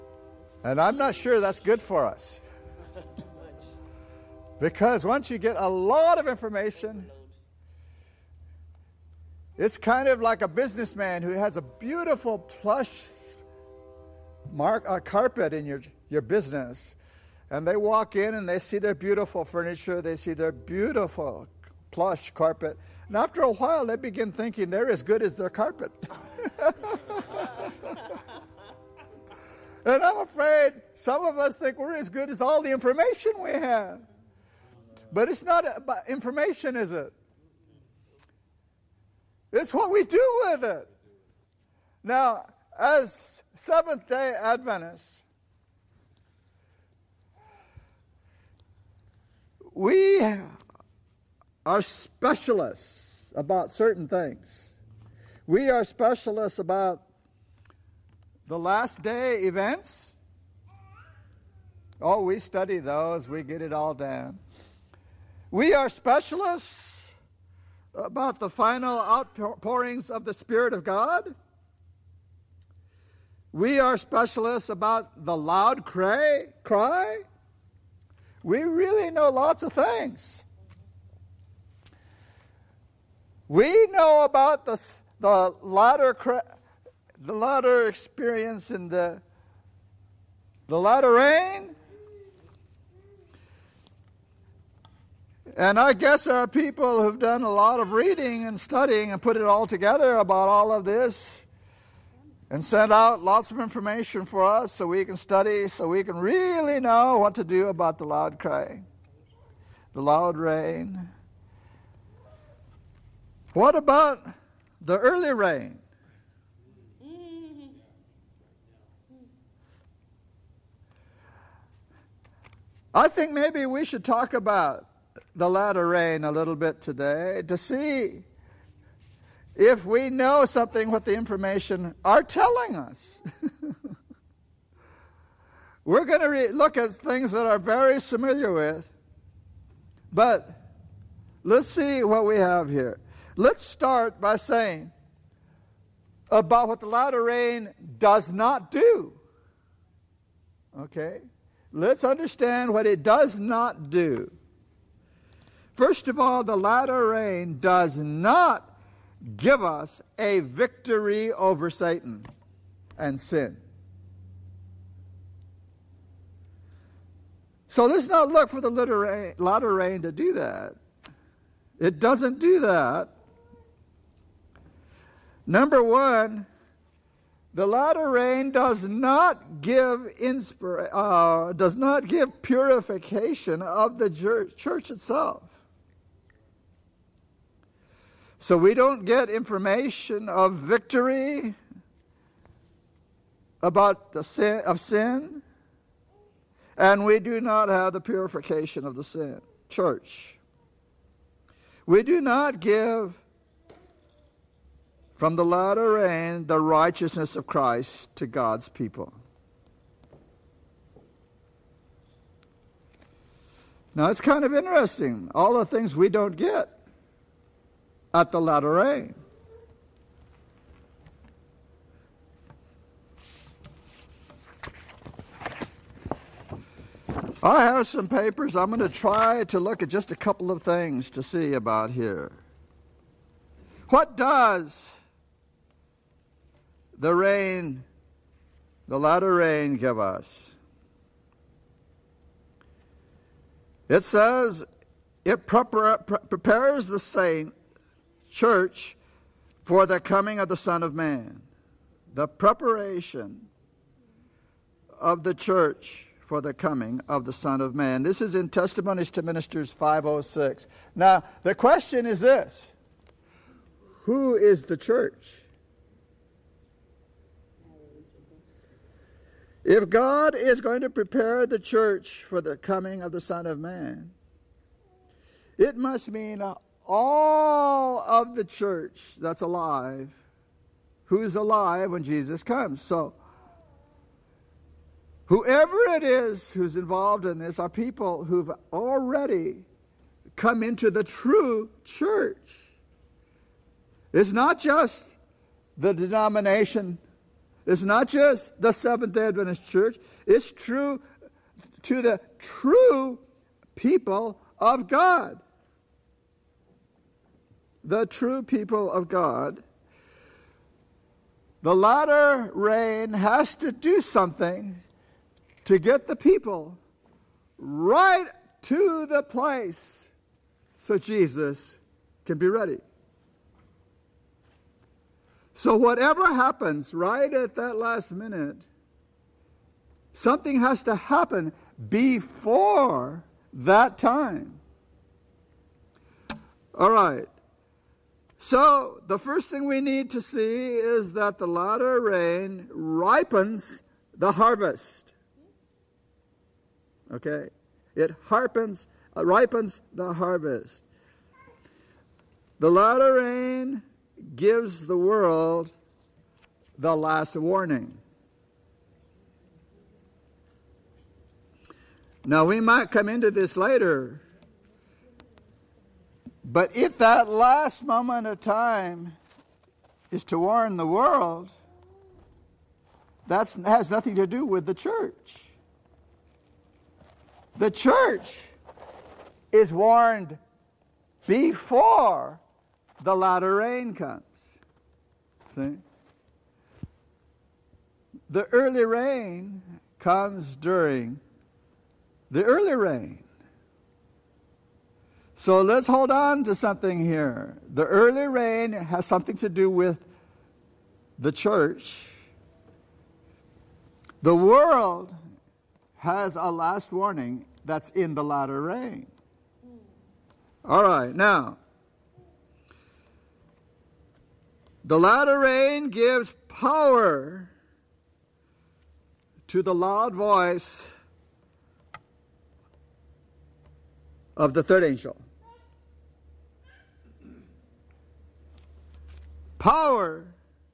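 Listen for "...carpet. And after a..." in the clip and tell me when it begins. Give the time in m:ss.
0:22.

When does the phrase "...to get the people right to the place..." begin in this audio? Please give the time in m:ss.
5:15.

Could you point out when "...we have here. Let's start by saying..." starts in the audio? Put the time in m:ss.
2:22.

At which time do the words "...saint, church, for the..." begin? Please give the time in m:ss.
4:06.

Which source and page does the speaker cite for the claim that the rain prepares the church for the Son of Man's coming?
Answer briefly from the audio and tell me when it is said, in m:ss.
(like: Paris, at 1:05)
Testimonies to Ministers 506, at 4:18.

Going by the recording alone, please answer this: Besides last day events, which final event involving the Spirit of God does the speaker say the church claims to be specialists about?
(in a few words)
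final outpourings.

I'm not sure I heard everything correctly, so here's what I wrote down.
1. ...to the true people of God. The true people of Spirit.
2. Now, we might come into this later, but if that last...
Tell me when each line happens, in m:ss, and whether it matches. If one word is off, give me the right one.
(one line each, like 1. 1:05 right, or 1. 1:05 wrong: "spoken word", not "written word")
1. 5:01 wrong: "God", not "Spirit"
2. 6:02 right.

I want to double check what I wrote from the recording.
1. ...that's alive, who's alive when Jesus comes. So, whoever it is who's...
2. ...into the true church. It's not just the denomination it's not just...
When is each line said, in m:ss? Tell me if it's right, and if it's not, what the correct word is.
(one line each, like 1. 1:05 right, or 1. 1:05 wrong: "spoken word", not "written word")
1. 4:39 right
2. 4:50 right.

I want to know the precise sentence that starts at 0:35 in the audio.
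But it's not about information, is it?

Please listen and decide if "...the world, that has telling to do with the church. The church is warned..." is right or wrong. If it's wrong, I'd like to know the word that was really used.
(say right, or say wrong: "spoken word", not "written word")
wrong: "nothing", not "telling".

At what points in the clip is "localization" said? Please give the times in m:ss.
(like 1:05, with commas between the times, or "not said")
not said.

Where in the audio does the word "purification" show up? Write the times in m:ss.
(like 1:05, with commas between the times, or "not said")
3:02, 3:18.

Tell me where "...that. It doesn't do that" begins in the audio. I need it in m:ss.
2:50.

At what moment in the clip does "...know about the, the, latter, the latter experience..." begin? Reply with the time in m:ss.
1:23.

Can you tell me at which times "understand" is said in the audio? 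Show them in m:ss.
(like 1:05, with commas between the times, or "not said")
2:32.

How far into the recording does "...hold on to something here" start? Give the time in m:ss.
6:35.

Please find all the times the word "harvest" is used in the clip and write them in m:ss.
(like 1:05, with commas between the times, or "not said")
5:44, 5:50.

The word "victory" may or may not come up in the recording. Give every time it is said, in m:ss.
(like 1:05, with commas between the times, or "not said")
2:40, 3:10.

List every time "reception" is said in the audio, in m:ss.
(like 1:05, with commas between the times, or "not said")
not said.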